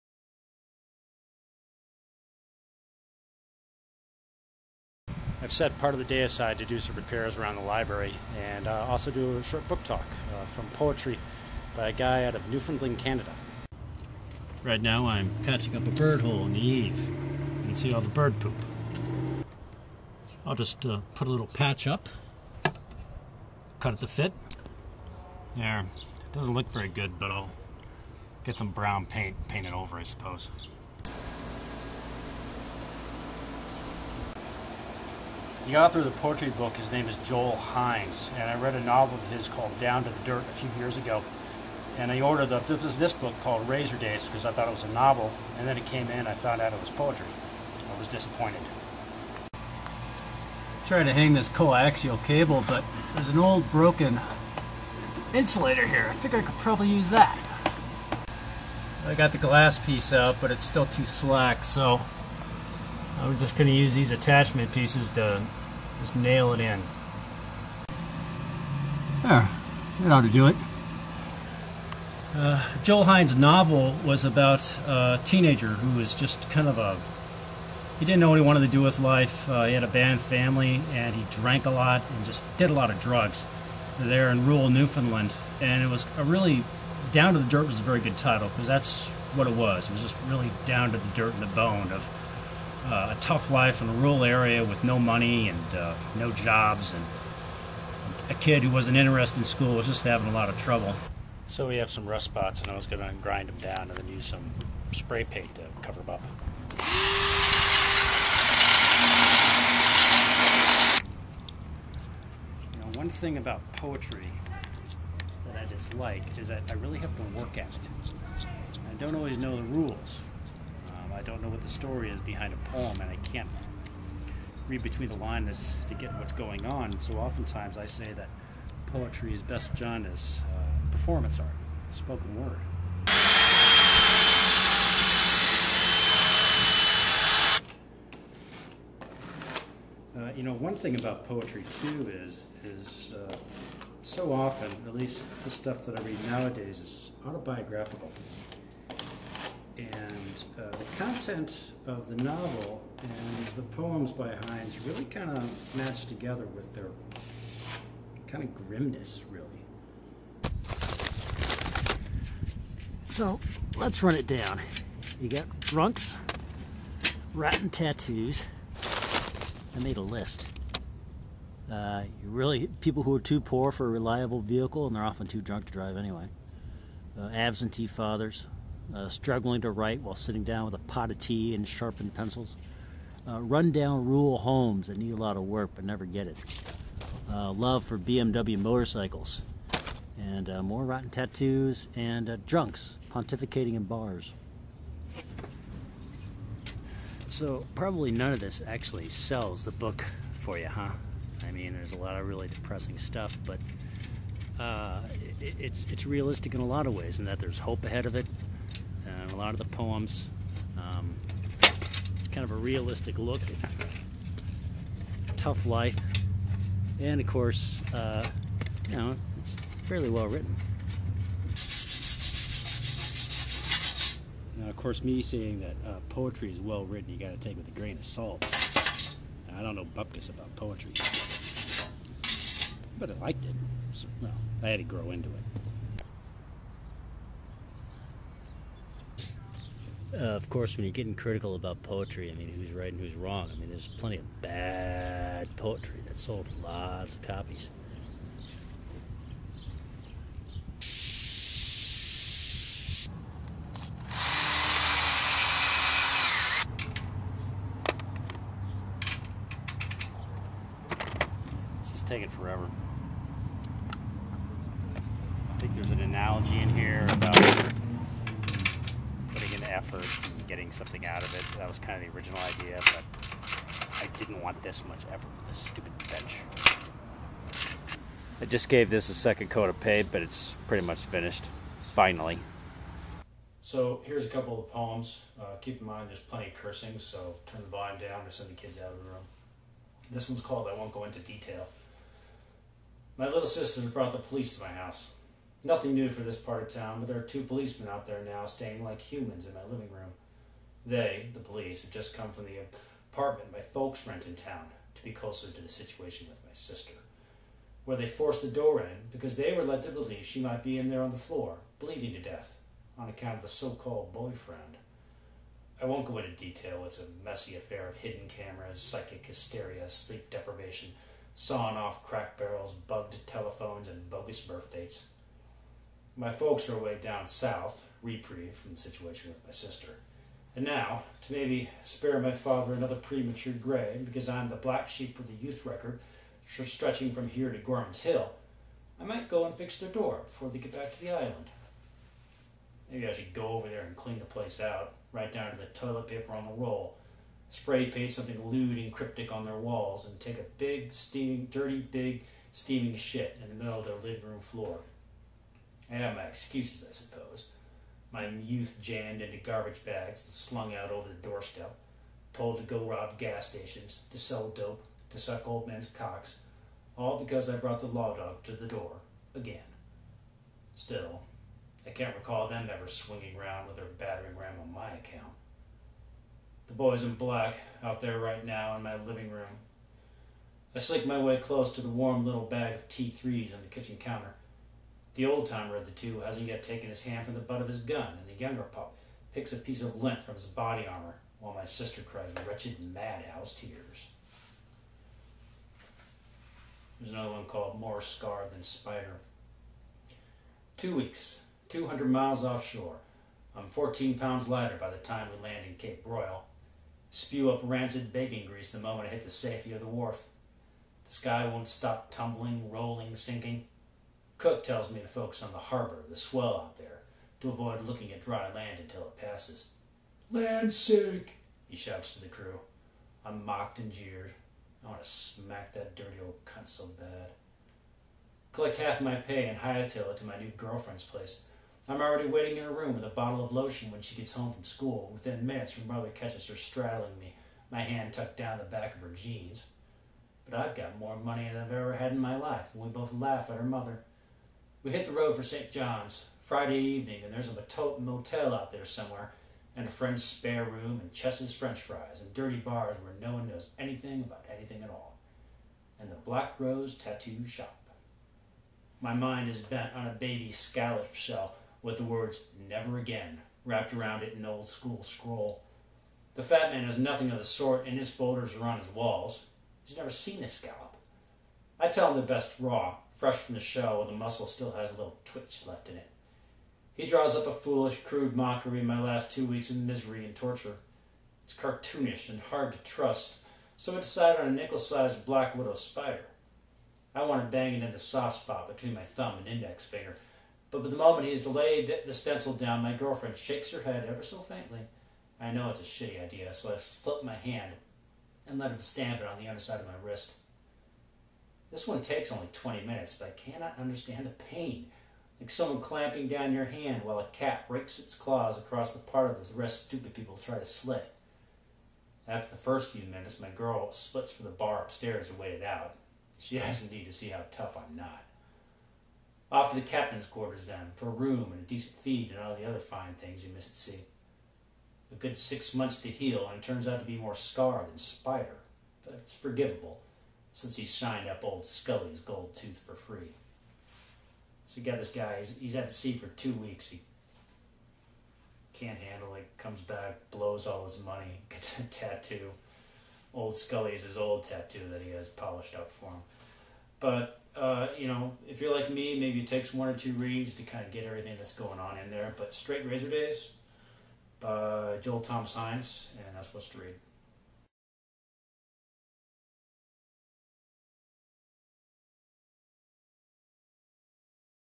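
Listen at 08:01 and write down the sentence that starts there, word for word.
It's cartoonish and hard to trust, so I decide on a nickel sized black widow spider.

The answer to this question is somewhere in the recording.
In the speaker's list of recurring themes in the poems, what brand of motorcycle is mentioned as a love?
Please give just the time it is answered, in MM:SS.
03:07.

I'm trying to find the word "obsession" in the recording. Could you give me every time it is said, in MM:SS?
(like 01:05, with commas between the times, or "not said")
not said.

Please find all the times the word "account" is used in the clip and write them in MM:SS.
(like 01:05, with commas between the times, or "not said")
05:13, 06:14.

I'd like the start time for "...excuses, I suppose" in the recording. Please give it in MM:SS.
05:56.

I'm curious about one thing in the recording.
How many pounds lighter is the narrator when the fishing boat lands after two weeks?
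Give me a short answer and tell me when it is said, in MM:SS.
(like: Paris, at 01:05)
14, at 06:43.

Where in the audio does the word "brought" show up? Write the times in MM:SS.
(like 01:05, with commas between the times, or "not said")
04:53, 06:07.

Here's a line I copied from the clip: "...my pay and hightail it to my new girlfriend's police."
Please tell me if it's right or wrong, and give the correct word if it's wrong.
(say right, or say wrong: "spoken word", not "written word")
wrong: "place", not "police".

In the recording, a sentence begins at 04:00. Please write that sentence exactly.
uh, of course, when you're getting critical about poetry, I mean, who's right and who's wrong?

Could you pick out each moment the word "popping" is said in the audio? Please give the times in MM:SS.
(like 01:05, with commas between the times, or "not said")
not said.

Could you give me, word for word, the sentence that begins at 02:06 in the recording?
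So oftentimes I say that poetry is best done as uh, performance art, spoken word.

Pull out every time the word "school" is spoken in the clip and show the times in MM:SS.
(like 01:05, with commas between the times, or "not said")
01:39, 07:14, 07:44.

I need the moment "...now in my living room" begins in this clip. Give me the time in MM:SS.
06:18.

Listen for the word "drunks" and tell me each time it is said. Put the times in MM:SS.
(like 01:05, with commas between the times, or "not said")
02:45, 02:55, 03:12.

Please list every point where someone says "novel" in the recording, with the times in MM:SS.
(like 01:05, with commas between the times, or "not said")
00:38, 00:44, 01:13, 02:32.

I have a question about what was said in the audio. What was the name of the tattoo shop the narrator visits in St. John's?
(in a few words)
Black Rose Tattoo Shop.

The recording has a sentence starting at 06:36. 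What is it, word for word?
There's another one called More Scar Than Spider.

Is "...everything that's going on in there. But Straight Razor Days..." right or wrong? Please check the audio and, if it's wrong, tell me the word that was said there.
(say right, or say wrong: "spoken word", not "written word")
right.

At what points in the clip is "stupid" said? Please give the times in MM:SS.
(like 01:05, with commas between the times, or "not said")
04:35, 08:29.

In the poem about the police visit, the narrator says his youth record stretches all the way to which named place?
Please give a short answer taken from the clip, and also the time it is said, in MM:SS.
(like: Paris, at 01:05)
Gorman's Hill, at 05:37.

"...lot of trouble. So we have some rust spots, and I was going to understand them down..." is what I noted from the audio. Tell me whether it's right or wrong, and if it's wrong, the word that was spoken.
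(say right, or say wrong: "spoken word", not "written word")
wrong: "grind", not "understand".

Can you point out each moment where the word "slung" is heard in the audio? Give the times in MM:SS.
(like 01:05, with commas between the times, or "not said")
06:00.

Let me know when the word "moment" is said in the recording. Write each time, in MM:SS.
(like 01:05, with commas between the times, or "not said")
06:48, 08:10.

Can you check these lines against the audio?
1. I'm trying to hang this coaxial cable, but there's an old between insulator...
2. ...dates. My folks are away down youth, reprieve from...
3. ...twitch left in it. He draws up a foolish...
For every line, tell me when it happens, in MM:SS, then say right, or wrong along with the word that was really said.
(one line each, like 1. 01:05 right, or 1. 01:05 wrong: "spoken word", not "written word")
1. 00:49 wrong: "broken", not "between"
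2. 05:24 wrong: "south", not "youth"
3. 07:55 right.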